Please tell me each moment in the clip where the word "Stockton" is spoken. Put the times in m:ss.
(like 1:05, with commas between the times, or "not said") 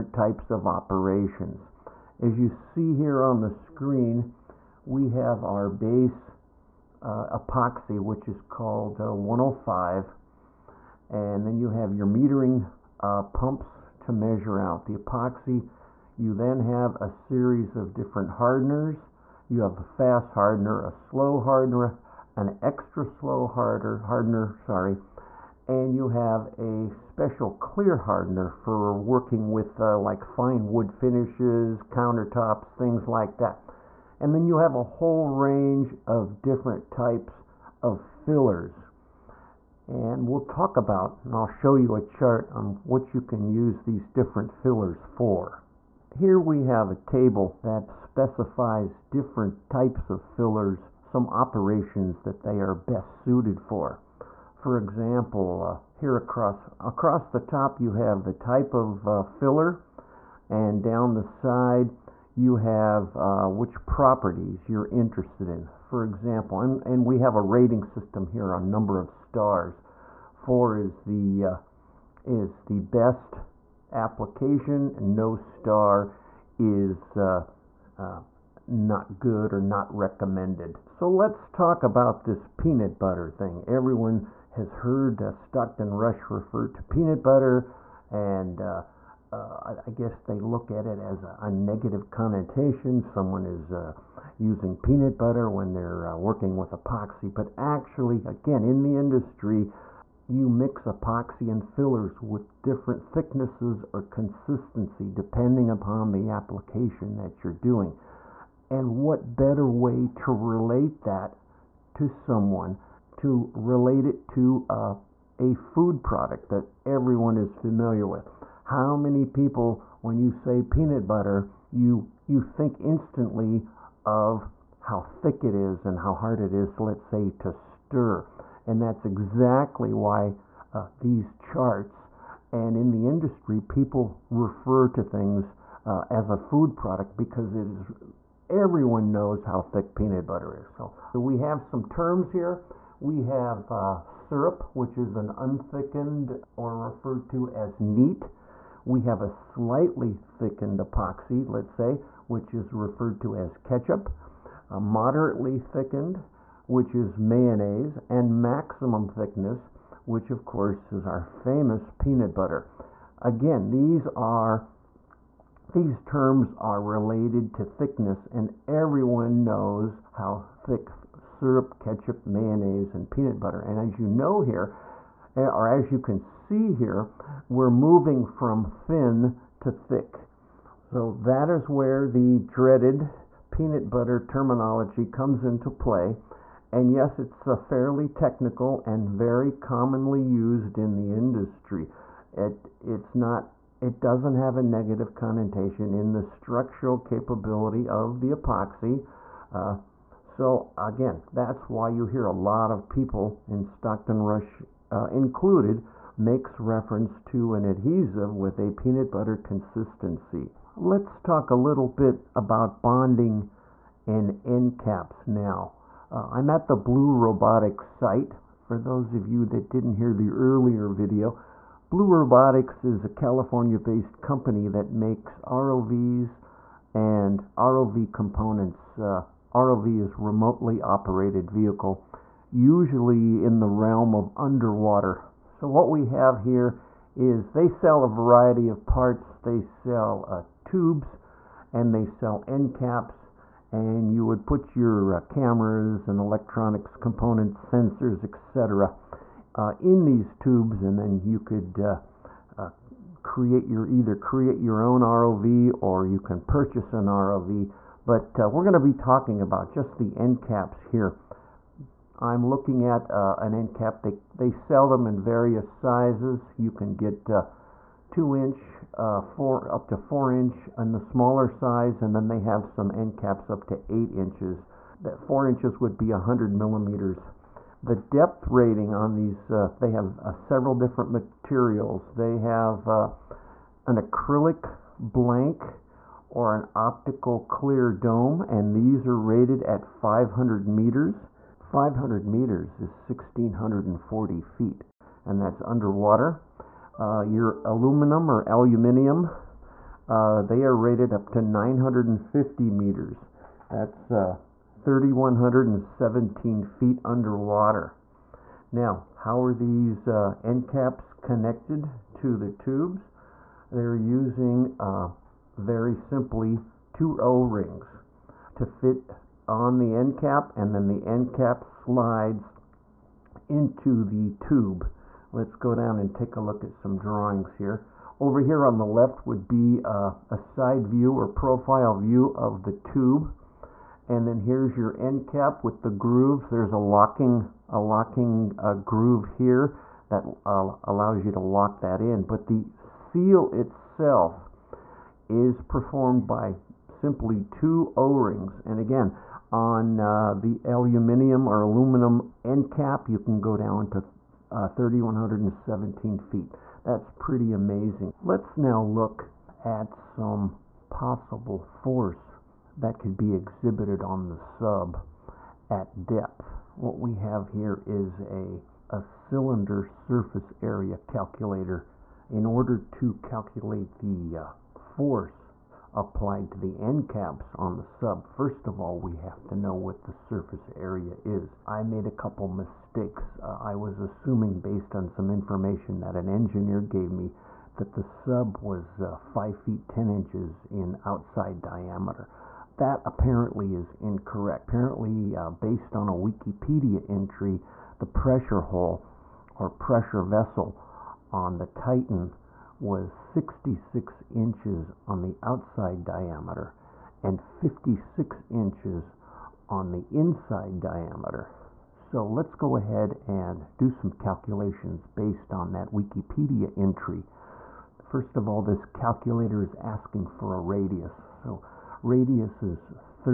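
1:25, 3:23.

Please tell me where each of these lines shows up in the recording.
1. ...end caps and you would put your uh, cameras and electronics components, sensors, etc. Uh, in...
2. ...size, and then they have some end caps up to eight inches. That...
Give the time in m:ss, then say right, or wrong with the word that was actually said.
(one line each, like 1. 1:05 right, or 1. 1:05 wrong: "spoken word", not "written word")
1. 4:02 right
2. 4:31 right.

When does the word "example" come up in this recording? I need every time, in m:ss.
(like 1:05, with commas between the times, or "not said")
0:54, 1:06.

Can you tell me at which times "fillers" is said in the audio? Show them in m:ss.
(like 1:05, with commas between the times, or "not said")
0:38, 0:44, 0:50, 0:59, 1:41.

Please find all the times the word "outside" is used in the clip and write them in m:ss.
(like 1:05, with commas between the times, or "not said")
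6:31, 6:45.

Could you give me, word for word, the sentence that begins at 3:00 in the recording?
So that is where the dreaded peanut butter terminology comes into play.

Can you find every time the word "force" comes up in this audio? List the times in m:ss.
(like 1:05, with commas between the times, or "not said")
6:01, 6:14.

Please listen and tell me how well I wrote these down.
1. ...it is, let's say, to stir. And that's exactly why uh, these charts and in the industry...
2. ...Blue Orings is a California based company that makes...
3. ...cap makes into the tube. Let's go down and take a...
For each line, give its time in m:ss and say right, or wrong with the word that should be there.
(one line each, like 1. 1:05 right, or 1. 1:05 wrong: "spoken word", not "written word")
1. 2:06 right
2. 3:41 wrong: "Robotics", not "Orings"
3. 5:21 wrong: "slides", not "makes".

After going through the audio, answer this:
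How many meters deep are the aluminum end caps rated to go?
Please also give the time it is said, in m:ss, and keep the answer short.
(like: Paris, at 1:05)
950 meters, at 5:01.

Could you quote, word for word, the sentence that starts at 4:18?
But uh, we're going to be talking about just the end caps here.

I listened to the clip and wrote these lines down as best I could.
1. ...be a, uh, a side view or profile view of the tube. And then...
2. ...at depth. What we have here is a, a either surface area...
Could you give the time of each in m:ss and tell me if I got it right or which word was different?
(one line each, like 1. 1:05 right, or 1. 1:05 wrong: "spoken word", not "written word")
1. 5:29 right
2. 6:05 wrong: "cylinder", not "either".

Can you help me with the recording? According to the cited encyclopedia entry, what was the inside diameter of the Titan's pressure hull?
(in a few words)
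56 inches.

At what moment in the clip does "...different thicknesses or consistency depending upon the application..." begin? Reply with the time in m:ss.
1:42.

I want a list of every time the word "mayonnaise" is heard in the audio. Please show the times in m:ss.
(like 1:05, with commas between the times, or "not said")
2:37, 2:52.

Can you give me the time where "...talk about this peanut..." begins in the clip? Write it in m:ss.
1:21.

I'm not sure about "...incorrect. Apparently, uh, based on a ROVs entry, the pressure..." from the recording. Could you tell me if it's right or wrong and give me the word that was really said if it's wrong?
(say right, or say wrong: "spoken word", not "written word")
wrong: "Wikipedia", not "ROVs".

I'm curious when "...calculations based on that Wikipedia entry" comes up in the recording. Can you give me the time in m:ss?
6:54.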